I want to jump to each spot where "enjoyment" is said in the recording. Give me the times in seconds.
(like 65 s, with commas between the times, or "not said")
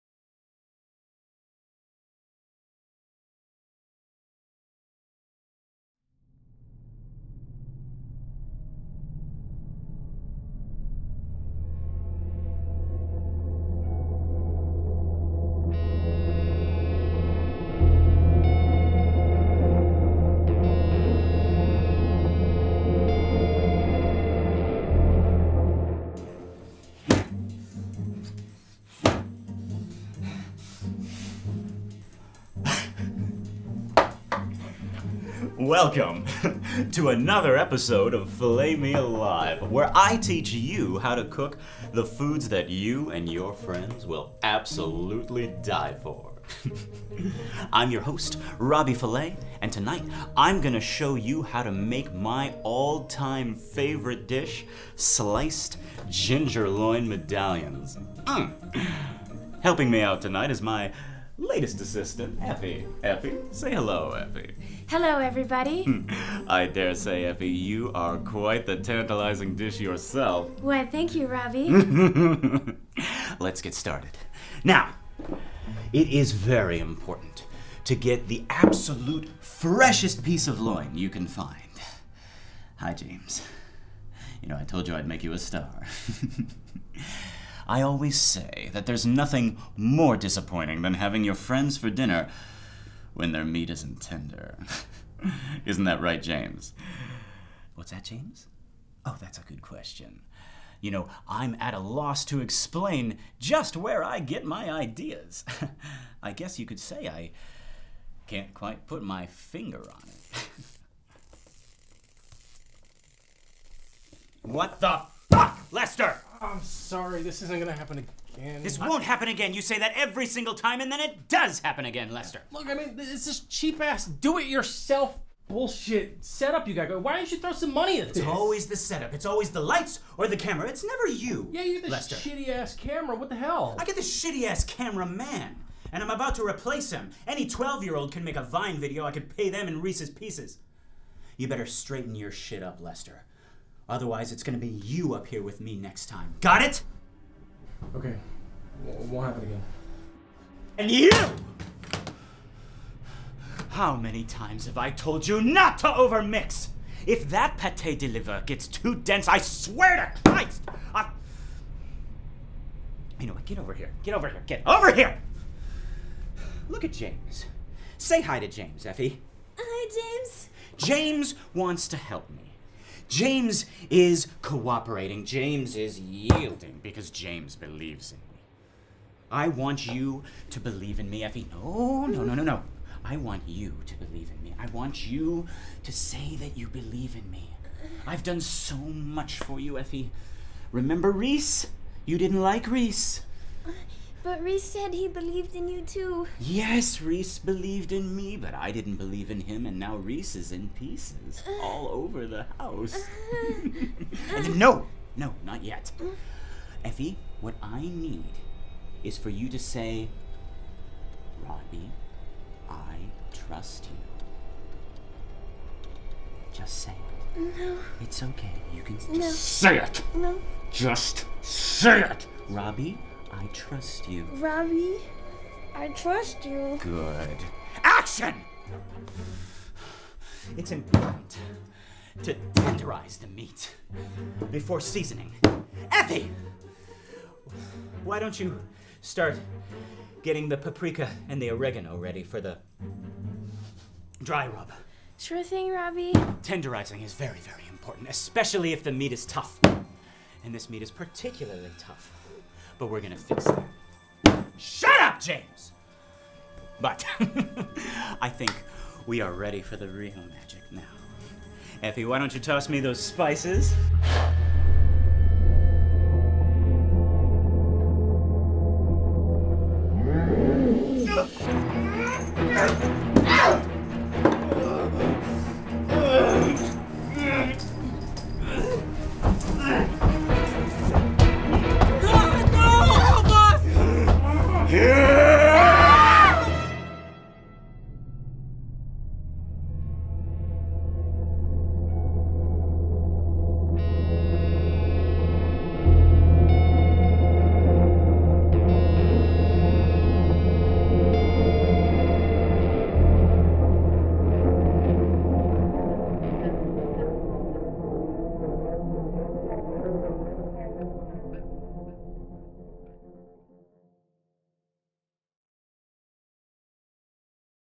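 not said.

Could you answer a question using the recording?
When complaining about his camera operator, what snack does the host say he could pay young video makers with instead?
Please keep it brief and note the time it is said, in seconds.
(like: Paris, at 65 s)
Reese's Pieces, at 139 s.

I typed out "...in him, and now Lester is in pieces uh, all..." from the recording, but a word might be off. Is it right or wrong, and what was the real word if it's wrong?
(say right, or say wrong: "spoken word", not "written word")
wrong: "Reese", not "Lester".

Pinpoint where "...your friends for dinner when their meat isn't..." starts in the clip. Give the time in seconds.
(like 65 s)
91 s.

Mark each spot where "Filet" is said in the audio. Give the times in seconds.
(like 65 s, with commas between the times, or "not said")
38 s, 48 s.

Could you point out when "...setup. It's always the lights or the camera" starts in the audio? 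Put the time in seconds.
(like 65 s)
128 s.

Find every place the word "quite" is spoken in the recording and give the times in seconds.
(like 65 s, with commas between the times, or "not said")
68 s, 108 s.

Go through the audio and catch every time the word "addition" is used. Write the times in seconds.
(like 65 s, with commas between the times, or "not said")
not said.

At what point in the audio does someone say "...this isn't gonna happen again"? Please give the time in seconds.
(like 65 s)
117 s.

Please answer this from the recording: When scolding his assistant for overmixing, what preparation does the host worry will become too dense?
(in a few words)
pate de liver.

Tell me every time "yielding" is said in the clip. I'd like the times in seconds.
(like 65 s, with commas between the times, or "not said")
175 s.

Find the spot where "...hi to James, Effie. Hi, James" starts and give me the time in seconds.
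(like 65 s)
168 s.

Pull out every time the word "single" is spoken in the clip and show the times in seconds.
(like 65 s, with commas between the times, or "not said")
120 s.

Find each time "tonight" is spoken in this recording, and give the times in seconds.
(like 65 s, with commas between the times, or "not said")
49 s, 60 s.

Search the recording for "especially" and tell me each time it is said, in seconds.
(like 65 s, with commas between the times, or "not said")
248 s.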